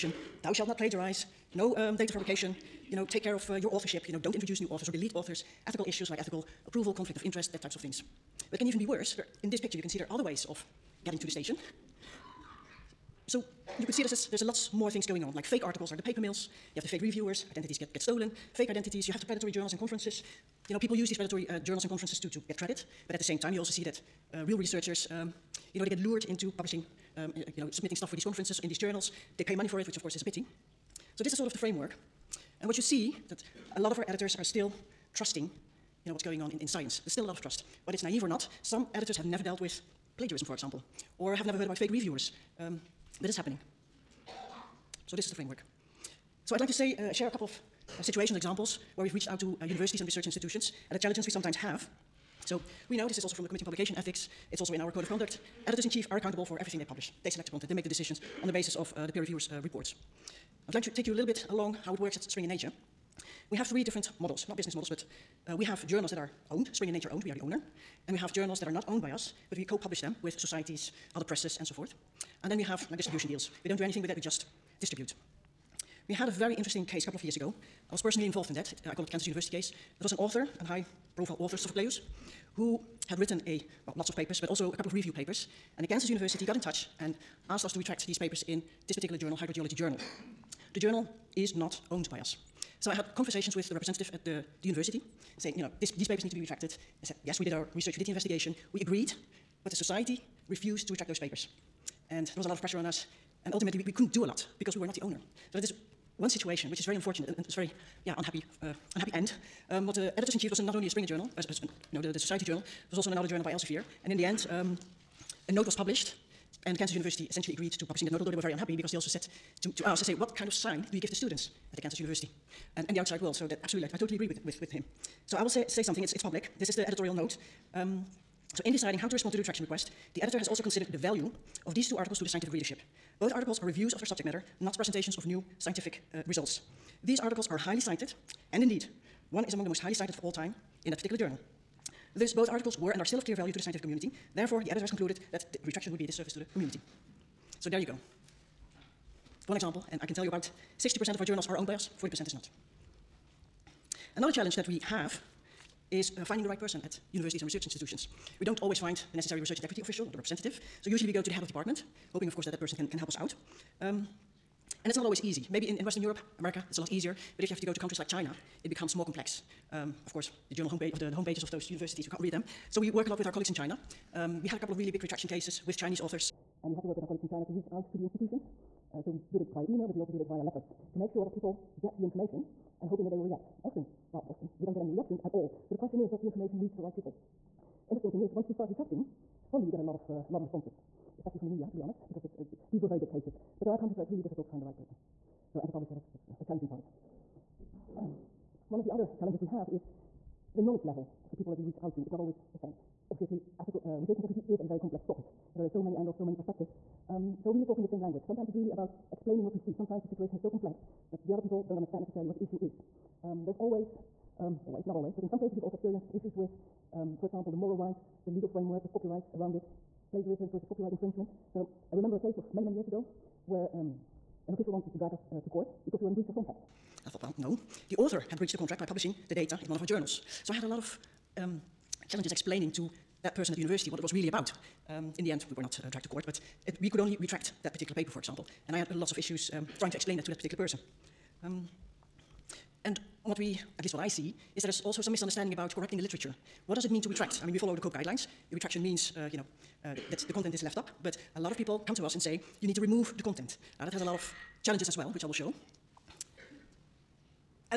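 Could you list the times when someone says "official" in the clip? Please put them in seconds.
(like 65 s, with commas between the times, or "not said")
159 s, 224 s.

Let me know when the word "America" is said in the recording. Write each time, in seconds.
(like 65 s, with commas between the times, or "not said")
166 s.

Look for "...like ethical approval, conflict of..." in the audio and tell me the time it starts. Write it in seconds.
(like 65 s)
6 s.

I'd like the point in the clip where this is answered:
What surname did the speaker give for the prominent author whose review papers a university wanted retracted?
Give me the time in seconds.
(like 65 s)
81 s.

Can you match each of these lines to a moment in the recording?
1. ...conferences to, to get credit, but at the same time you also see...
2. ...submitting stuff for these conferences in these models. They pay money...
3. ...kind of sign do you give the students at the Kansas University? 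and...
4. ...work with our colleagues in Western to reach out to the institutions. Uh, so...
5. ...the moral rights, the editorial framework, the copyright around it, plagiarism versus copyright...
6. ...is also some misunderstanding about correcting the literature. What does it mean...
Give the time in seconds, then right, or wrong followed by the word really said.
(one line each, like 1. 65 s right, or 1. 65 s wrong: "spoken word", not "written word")
1. 21 s right
2. 27 s wrong: "journals", not "models"
3. 120 s right
4. 176 s wrong: "China", not "Western"
5. 217 s wrong: "legal", not "editorial"
6. 244 s right.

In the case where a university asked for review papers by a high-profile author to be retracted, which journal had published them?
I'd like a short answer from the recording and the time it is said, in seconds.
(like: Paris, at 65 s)
Hydrogeology Journal, at 89 s.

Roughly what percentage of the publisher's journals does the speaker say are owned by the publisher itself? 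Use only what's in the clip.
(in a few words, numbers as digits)
60%.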